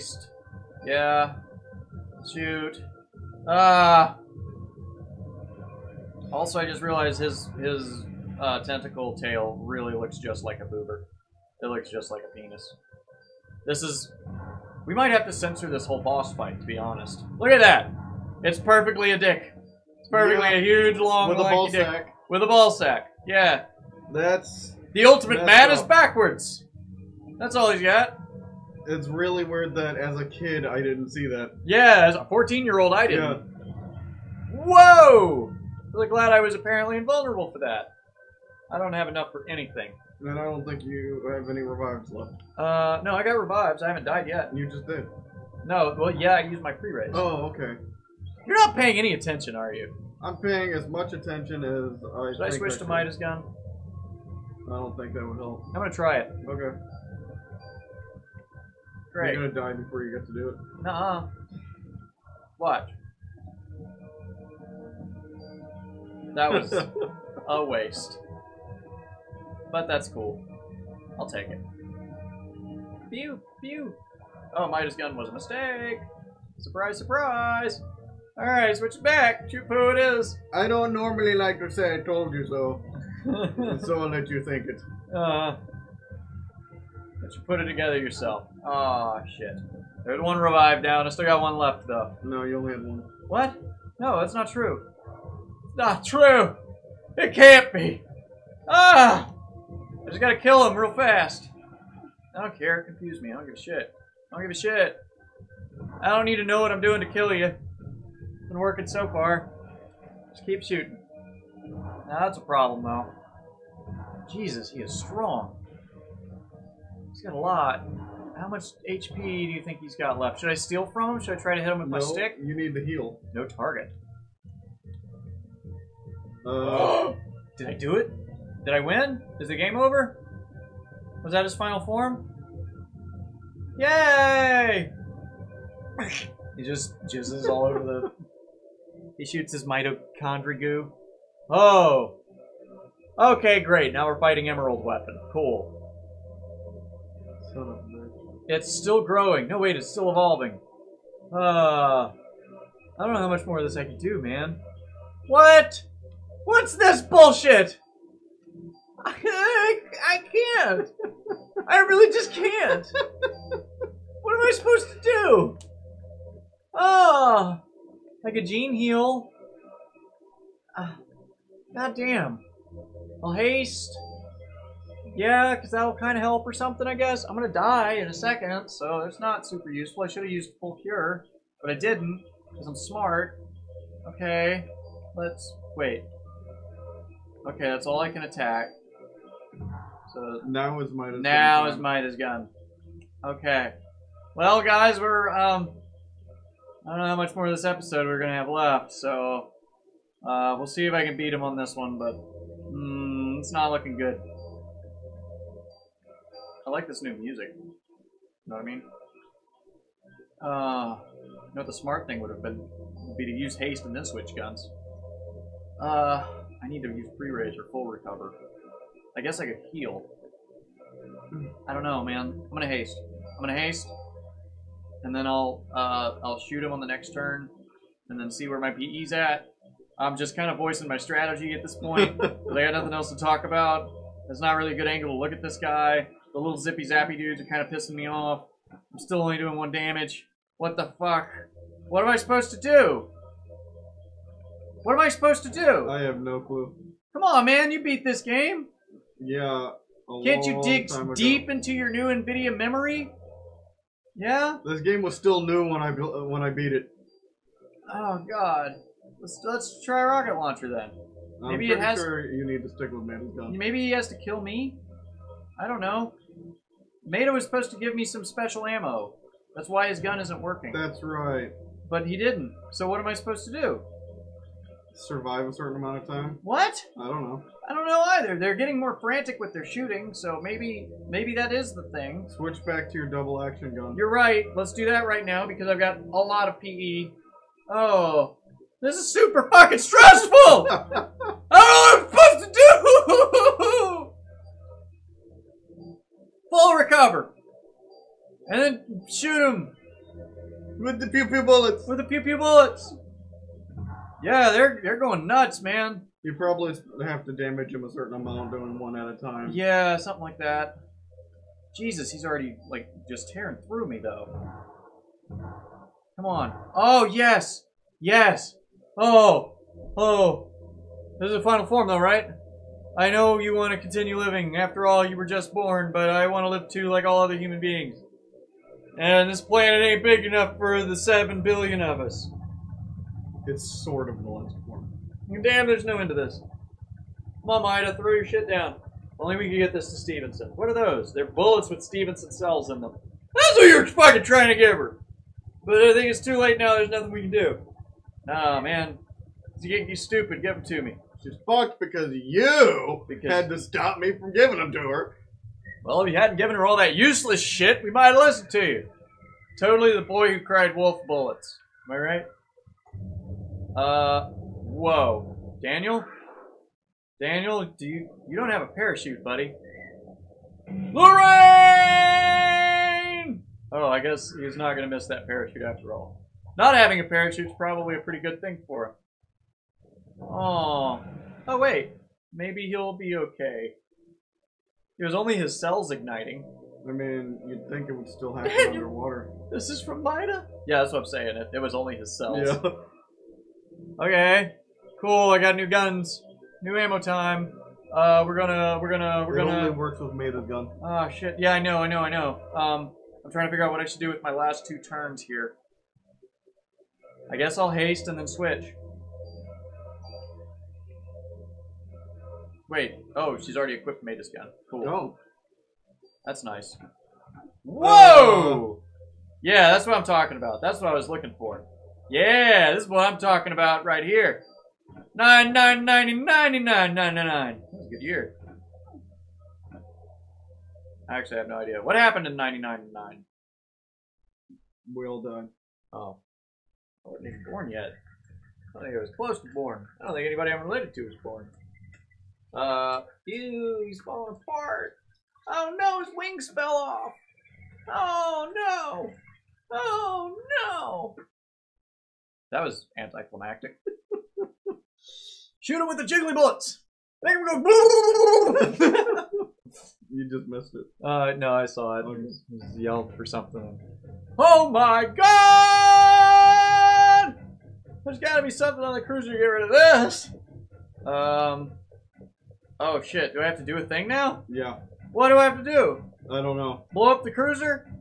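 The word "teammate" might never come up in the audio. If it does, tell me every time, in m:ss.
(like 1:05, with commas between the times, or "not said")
not said.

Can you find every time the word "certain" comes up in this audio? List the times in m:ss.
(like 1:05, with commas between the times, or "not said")
4:35, 5:07.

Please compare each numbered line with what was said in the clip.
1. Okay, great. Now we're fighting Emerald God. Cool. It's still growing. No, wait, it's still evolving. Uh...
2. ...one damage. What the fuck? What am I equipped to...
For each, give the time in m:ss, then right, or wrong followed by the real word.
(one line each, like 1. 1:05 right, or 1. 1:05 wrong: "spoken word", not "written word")
1. 2:23 wrong: "Weapon", not "God"
2. 3:59 wrong: "supposed", not "equipped".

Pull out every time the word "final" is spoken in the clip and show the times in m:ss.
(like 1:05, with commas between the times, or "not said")
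2:11, 5:21.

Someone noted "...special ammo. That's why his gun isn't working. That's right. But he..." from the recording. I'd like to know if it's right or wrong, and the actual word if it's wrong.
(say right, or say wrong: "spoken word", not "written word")
right.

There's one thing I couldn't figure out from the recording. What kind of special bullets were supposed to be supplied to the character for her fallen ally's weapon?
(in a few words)
Stevenson cells.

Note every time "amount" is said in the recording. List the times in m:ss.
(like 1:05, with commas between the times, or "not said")
4:35, 5:08.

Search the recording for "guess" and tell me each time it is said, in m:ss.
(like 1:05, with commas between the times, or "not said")
2:56, 3:39, 6:13, 6:47.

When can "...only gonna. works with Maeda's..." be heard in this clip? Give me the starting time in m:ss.
6:39.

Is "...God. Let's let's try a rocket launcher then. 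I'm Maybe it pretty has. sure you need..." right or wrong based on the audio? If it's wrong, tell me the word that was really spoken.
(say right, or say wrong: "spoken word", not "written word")
right.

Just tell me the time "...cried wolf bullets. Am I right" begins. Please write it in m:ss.
6:00.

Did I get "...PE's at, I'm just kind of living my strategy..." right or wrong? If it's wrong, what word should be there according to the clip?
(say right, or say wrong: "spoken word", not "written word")
wrong: "voicing", not "living".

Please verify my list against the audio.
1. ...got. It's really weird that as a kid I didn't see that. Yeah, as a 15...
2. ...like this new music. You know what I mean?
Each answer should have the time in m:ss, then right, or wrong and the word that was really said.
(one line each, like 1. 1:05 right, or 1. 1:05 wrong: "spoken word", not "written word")
1. 0:27 wrong: "14", not "15"
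2. 3:26 right.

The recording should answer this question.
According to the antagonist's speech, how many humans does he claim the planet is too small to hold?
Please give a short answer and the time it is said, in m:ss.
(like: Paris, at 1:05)
7 billion, at 5:30.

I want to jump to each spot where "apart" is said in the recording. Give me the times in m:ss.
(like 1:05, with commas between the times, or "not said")
7:24.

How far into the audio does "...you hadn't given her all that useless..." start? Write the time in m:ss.
5:56.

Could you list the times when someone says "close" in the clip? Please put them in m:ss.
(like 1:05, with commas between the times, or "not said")
7:19.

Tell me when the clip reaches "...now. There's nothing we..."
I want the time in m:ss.
5:46.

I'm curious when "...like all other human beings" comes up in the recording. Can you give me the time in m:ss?
5:26.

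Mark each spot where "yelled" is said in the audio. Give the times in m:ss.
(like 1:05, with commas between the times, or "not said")
7:42.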